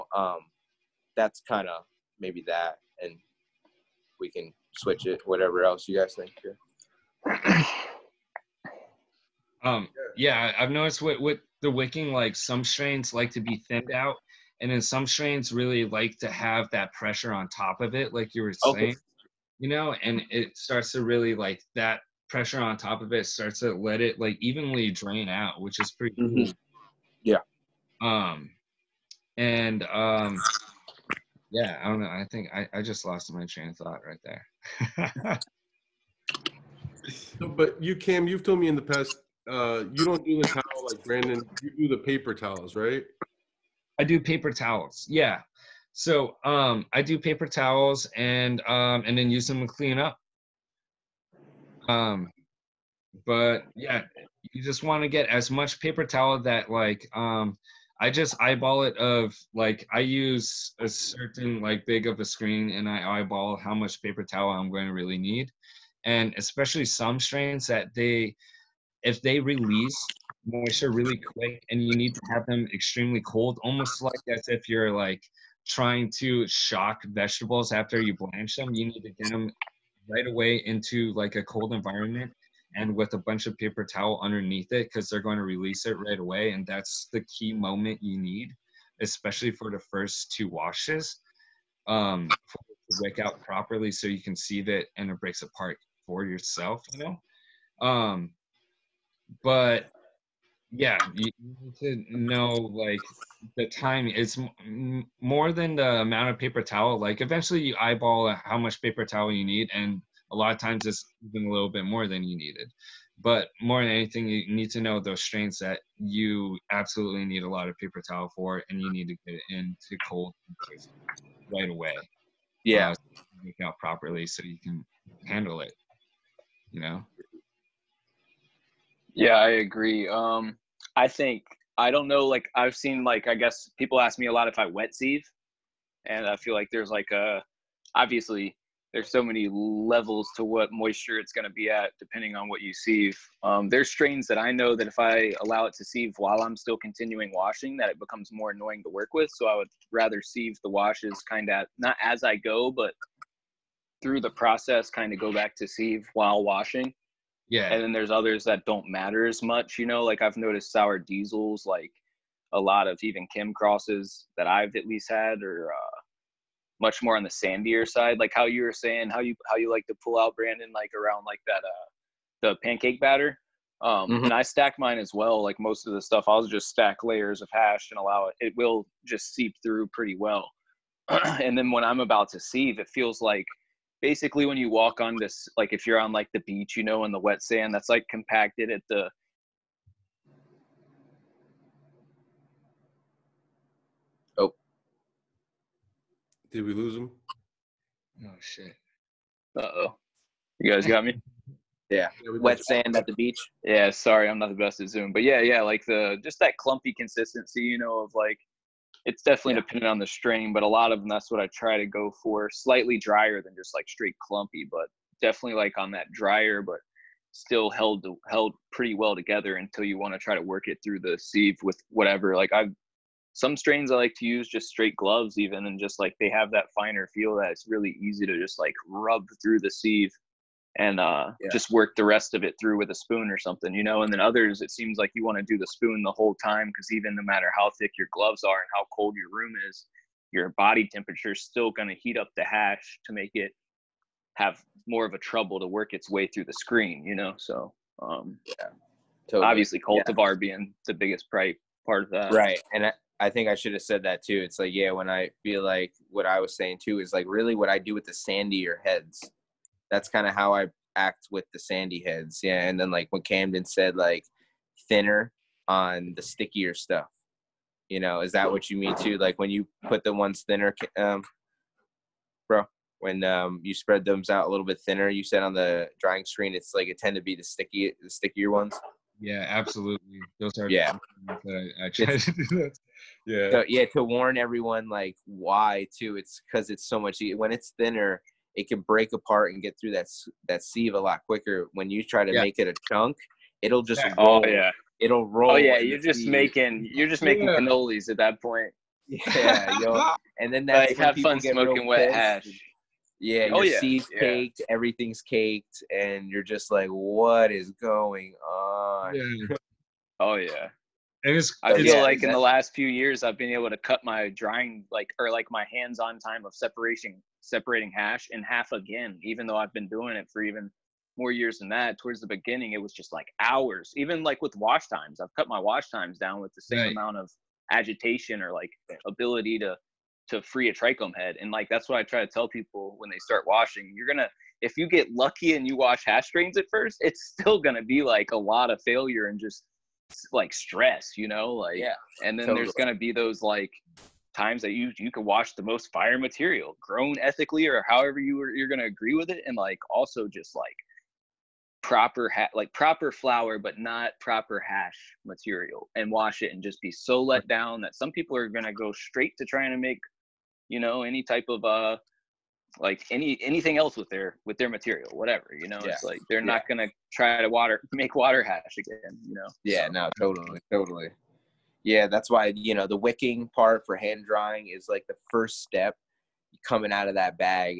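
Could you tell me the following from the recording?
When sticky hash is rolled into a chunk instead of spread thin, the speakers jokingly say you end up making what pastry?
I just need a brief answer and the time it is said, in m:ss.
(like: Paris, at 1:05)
Cannolis, at 4:57.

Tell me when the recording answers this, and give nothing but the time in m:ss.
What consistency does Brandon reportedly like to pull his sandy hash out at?
2:52.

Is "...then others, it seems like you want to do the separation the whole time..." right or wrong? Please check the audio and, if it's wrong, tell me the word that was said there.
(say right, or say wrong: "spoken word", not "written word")
wrong: "spoon", not "separation".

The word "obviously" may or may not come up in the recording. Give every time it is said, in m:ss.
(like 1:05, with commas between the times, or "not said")
2:17, 4:09.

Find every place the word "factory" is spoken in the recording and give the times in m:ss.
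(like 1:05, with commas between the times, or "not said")
not said.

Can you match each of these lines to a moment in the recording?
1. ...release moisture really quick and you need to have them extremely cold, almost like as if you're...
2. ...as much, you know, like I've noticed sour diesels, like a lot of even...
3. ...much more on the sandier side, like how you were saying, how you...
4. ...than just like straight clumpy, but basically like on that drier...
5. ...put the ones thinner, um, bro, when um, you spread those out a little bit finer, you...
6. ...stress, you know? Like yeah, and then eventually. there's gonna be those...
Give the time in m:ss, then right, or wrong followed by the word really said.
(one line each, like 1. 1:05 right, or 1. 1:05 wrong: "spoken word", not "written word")
1. 1:09 right
2. 2:39 right
3. 2:46 right
4. 3:33 wrong: "definitely", not "basically"
5. 4:29 wrong: "thinner", not "finer"
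6. 5:40 wrong: "totally", not "eventually".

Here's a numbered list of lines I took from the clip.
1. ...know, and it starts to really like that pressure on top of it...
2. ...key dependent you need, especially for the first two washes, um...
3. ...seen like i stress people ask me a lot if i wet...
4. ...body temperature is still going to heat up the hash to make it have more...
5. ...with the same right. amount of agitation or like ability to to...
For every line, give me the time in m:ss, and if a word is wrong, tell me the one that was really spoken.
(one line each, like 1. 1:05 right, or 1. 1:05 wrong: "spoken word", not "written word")
1. 0:19 right
2. 1:27 wrong: "moment", not "dependent"
3. 2:12 wrong: "guess", not "stress"
4. 4:00 right
5. 5:26 right.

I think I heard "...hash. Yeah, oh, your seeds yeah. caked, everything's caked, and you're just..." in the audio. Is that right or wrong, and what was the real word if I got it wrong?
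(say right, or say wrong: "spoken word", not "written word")
right.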